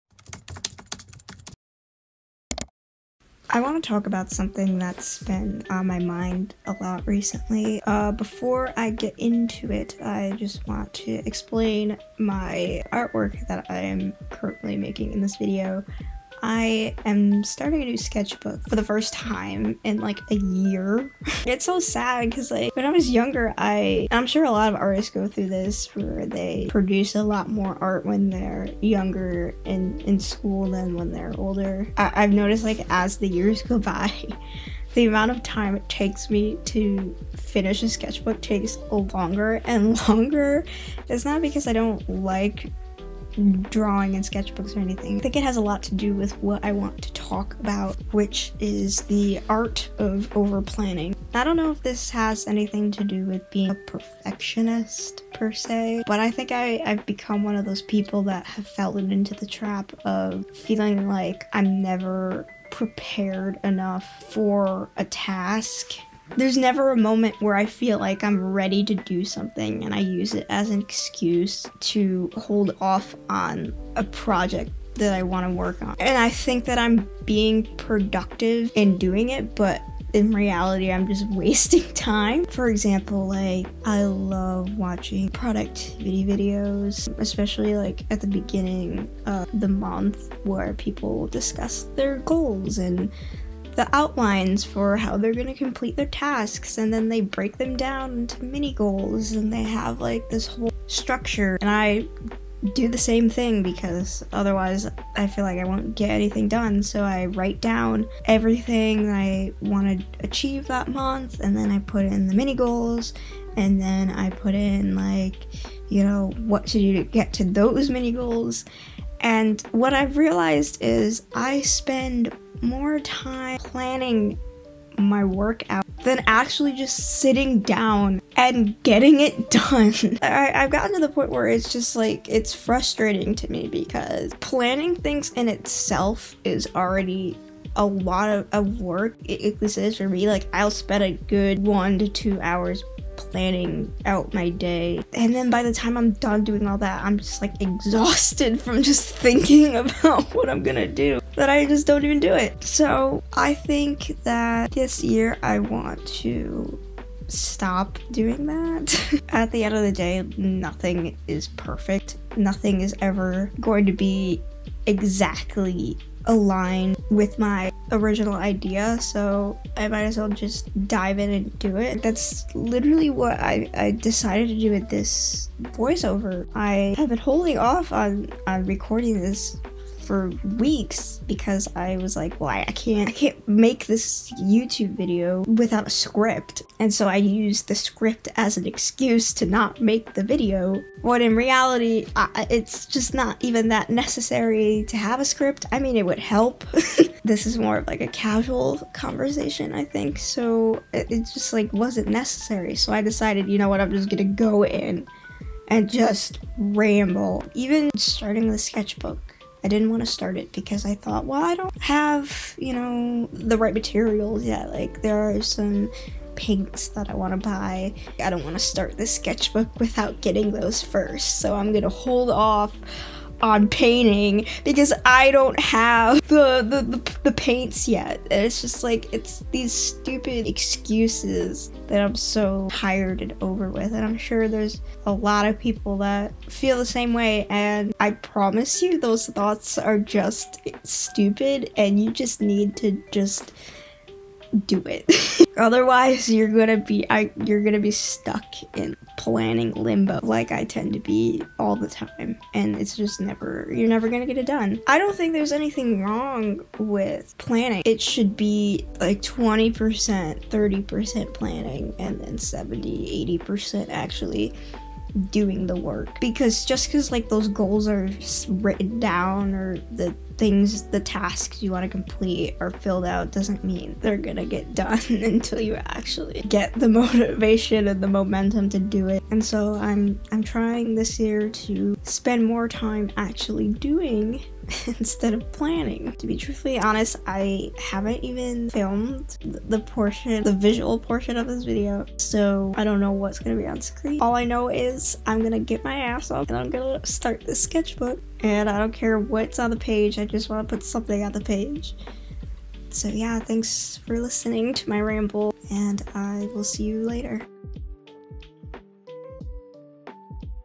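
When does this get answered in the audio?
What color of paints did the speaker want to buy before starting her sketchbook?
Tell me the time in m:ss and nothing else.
3:36.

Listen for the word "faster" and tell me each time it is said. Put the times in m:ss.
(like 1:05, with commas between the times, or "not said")
not said.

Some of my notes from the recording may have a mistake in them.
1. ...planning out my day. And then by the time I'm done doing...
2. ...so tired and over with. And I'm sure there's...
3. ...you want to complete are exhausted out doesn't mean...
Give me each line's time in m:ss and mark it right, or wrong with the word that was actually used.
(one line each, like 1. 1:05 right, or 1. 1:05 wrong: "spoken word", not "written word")
1. 2:23 right
2. 3:52 right
3. 4:31 wrong: "filled", not "exhausted".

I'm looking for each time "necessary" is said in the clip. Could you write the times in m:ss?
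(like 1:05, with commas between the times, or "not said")
3:13, 3:22.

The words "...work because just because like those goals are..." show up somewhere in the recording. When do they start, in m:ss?
4:25.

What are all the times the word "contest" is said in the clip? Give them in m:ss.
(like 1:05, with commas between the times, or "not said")
not said.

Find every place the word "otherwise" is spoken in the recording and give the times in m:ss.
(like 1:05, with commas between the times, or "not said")
1:44, 4:05.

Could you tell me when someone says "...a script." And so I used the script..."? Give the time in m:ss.
3:05.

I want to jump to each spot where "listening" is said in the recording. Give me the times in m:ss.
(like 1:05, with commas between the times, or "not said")
5:04.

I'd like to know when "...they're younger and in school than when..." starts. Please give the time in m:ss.
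0:28.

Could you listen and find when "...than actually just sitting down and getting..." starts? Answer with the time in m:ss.
2:06.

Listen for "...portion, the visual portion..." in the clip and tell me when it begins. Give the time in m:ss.
4:49.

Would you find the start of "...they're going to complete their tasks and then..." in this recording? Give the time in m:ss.
1:35.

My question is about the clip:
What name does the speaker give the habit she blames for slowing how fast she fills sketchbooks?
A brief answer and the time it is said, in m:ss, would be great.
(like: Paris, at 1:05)
the art of over planning, at 0:49.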